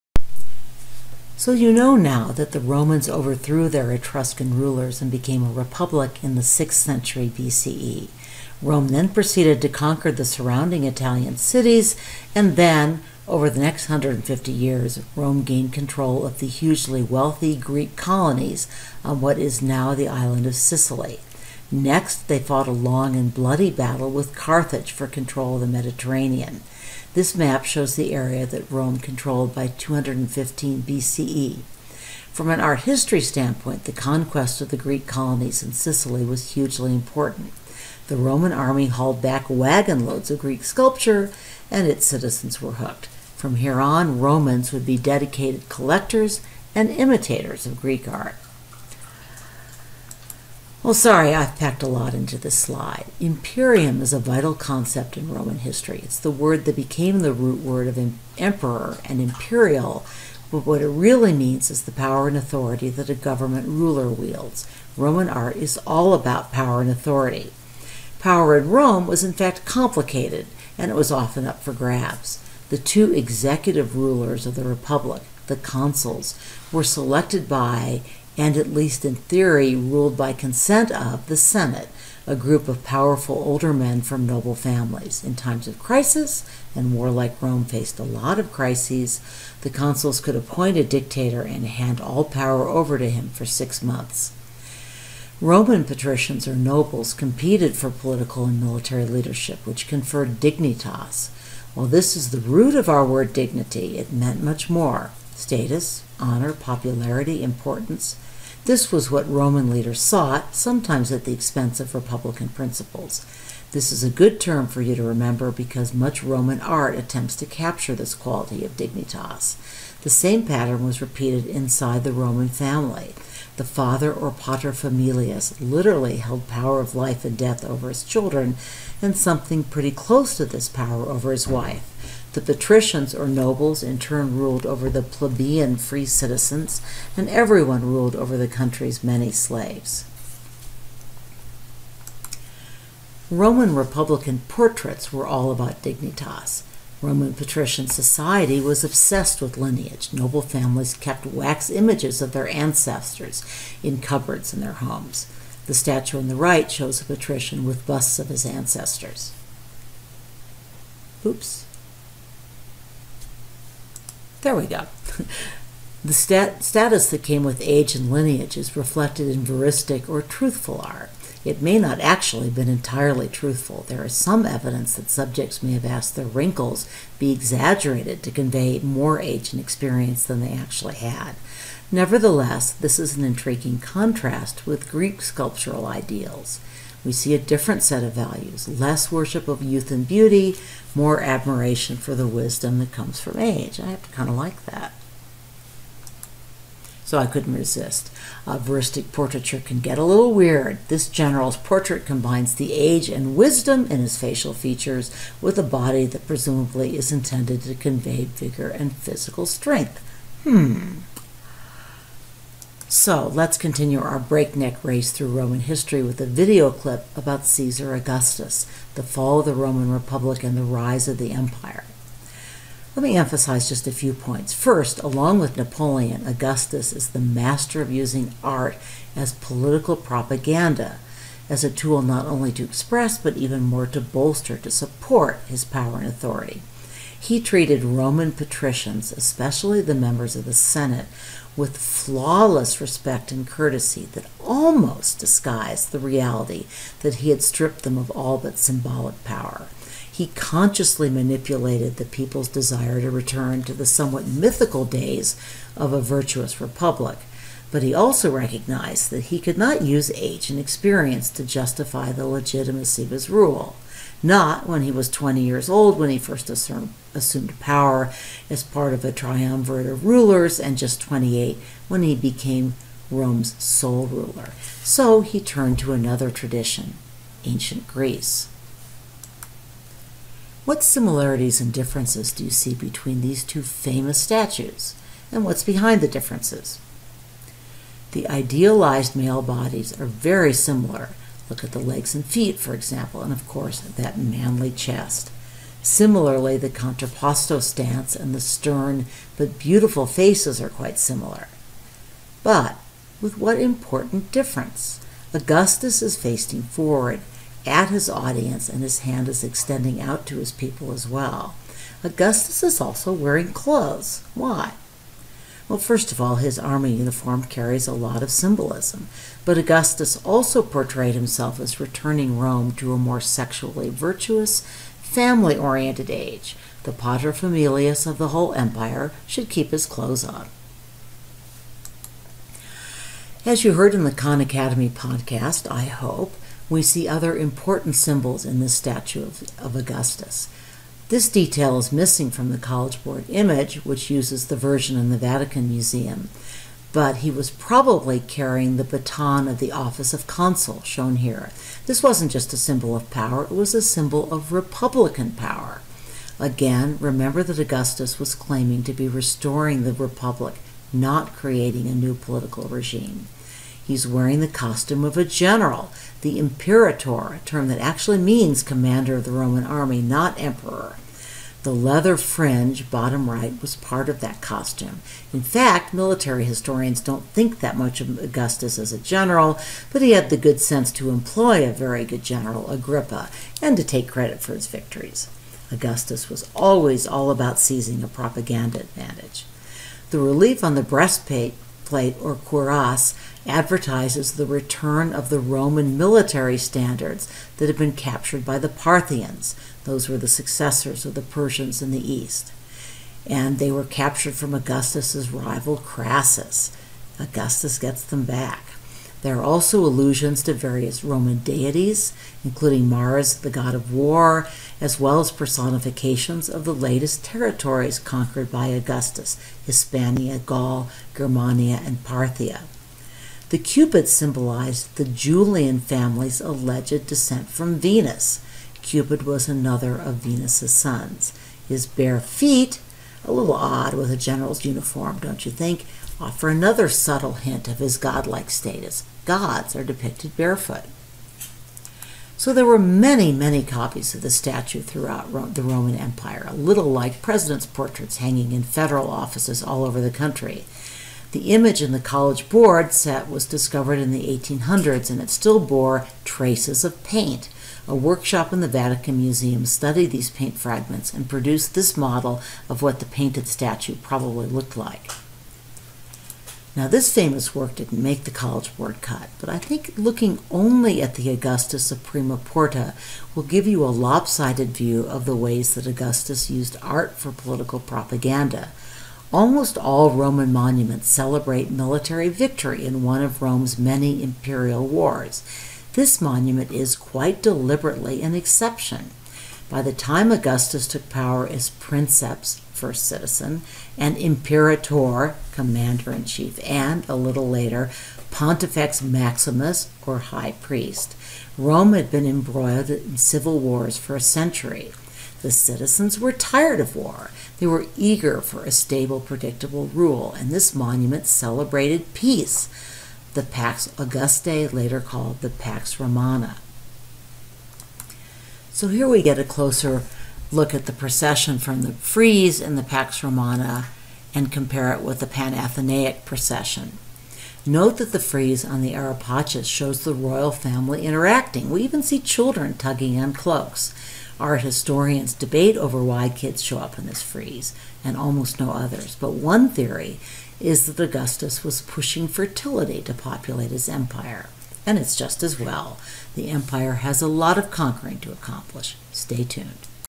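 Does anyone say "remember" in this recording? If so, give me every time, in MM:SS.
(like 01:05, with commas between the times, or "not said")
01:55, 05:57.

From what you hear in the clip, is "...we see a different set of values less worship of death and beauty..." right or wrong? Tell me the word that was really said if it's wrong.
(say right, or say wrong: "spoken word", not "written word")
wrong: "youth", not "death".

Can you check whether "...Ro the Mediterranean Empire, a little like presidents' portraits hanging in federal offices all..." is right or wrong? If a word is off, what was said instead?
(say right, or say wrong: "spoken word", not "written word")
wrong: "Roman", not "Mediterranean".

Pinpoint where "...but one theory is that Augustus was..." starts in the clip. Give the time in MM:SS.
08:59.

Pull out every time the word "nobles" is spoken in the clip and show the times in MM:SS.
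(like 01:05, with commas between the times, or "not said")
01:24, 01:36, 02:13, 02:30.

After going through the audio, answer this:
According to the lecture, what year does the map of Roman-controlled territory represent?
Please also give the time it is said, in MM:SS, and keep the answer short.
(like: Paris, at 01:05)
215 BCE, at 00:29.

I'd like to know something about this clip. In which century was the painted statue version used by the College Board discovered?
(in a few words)
1800s.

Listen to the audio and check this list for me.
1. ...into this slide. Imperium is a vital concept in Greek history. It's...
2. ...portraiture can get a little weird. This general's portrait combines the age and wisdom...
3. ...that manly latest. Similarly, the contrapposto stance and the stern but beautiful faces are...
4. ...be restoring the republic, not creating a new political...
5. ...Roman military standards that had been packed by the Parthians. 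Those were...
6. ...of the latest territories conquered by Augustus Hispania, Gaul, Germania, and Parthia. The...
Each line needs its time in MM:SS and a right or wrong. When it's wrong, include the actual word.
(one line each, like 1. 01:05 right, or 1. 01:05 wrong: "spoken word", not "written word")
1. 00:52 wrong: "Roman", not "Greek"
2. 03:19 right
3. 04:53 wrong: "chest", not "latest"
4. 05:58 right
5. 06:35 wrong: "captured", not "packed"
6. 06:56 right.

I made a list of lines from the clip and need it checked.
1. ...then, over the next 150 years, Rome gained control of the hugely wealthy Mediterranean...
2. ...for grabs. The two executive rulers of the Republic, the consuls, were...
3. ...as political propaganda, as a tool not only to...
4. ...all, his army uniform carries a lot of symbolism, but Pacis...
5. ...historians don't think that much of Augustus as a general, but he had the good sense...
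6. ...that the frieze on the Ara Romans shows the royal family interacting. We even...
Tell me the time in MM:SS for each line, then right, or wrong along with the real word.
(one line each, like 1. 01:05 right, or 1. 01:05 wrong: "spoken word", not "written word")
1. 00:12 wrong: "Greek", not "Mediterranean"
2. 01:11 right
3. 03:49 right
4. 05:16 wrong: "Augustus", not "Pacis"
5. 06:16 right
6. 08:47 wrong: "Pacis", not "Romans".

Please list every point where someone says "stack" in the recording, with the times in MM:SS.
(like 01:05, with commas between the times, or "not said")
not said.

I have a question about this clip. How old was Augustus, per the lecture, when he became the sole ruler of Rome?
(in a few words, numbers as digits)
28.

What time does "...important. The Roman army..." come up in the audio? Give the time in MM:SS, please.
00:36.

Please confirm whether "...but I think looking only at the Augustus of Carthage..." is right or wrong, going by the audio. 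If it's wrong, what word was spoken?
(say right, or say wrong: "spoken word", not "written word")
wrong: "Prima", not "Carthage".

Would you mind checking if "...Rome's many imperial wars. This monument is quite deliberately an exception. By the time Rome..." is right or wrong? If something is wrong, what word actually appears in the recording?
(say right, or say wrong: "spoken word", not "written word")
wrong: "Augustus", not "Rome".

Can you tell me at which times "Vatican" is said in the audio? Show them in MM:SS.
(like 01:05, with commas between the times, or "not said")
05:45, 07:38.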